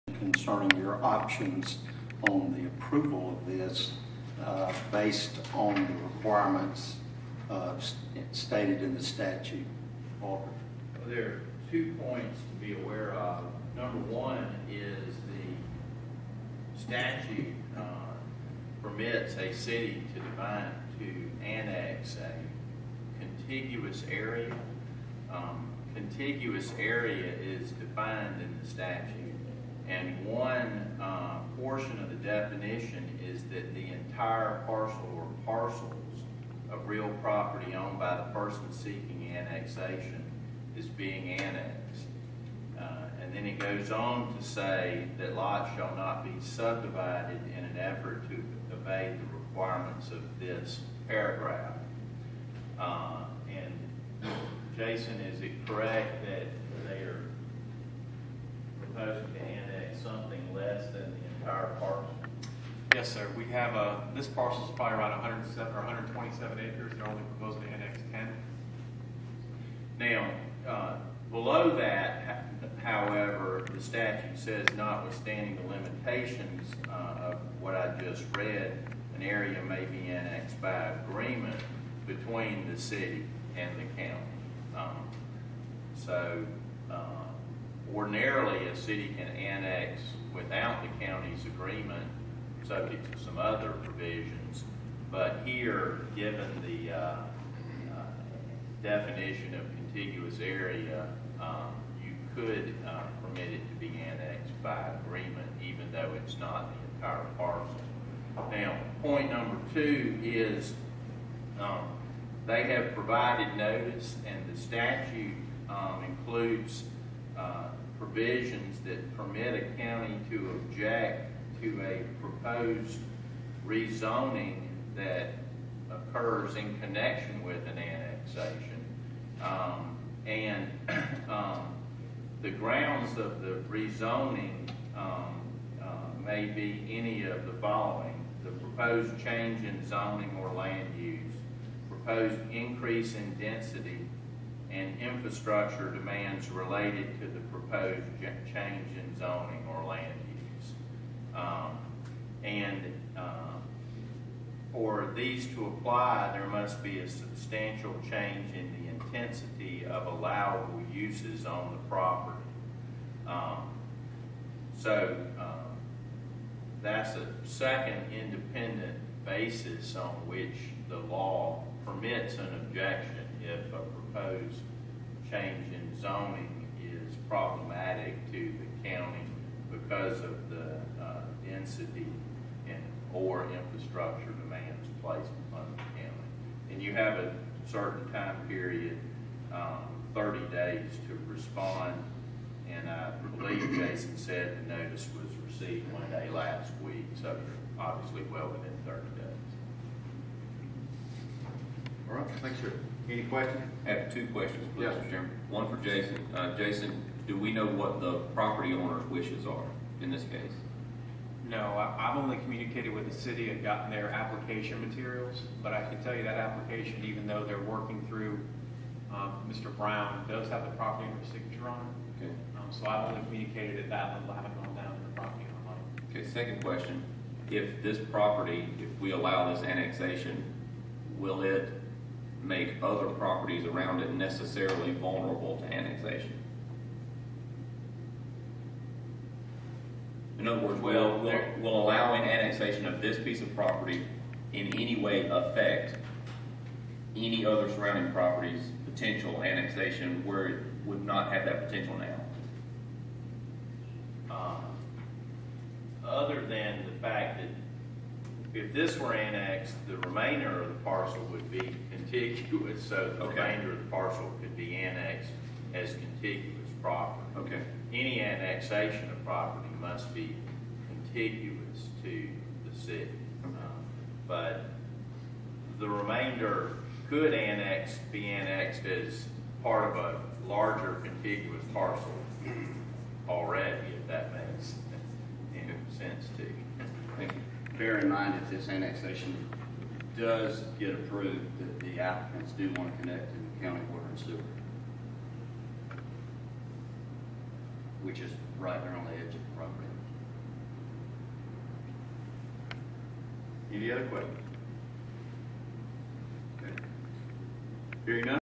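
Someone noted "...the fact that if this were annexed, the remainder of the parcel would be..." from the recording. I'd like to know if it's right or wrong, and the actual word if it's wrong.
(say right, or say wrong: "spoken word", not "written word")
right.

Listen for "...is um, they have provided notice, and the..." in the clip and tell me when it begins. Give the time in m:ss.
1:50.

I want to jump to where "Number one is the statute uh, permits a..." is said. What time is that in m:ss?
0:13.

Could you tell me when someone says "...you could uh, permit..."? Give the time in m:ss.
1:42.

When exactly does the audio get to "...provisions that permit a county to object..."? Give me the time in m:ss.
1:57.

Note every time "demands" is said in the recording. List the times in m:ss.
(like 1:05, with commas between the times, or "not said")
2:25, 3:04.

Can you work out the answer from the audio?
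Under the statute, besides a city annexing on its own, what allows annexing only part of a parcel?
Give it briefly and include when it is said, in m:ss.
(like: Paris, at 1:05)
agreement between the city and the county, at 1:21.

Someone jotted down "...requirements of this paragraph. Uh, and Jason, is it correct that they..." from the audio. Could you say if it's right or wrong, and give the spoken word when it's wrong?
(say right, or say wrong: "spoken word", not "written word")
right.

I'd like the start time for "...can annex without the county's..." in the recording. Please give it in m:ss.
1:29.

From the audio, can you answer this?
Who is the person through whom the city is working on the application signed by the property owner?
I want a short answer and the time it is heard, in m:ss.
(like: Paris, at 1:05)
Mr. Brown, at 3:39.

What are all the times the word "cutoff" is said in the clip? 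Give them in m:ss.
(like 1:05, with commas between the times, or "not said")
not said.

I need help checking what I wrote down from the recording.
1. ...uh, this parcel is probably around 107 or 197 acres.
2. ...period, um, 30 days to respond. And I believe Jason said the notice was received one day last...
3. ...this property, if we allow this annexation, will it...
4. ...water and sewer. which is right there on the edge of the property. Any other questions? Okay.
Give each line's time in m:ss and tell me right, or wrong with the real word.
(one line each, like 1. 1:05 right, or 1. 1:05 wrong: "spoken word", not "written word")
1. 1:03 wrong: "127", not "197"
2. 3:08 right
3. 3:47 right
4. 4:53 right.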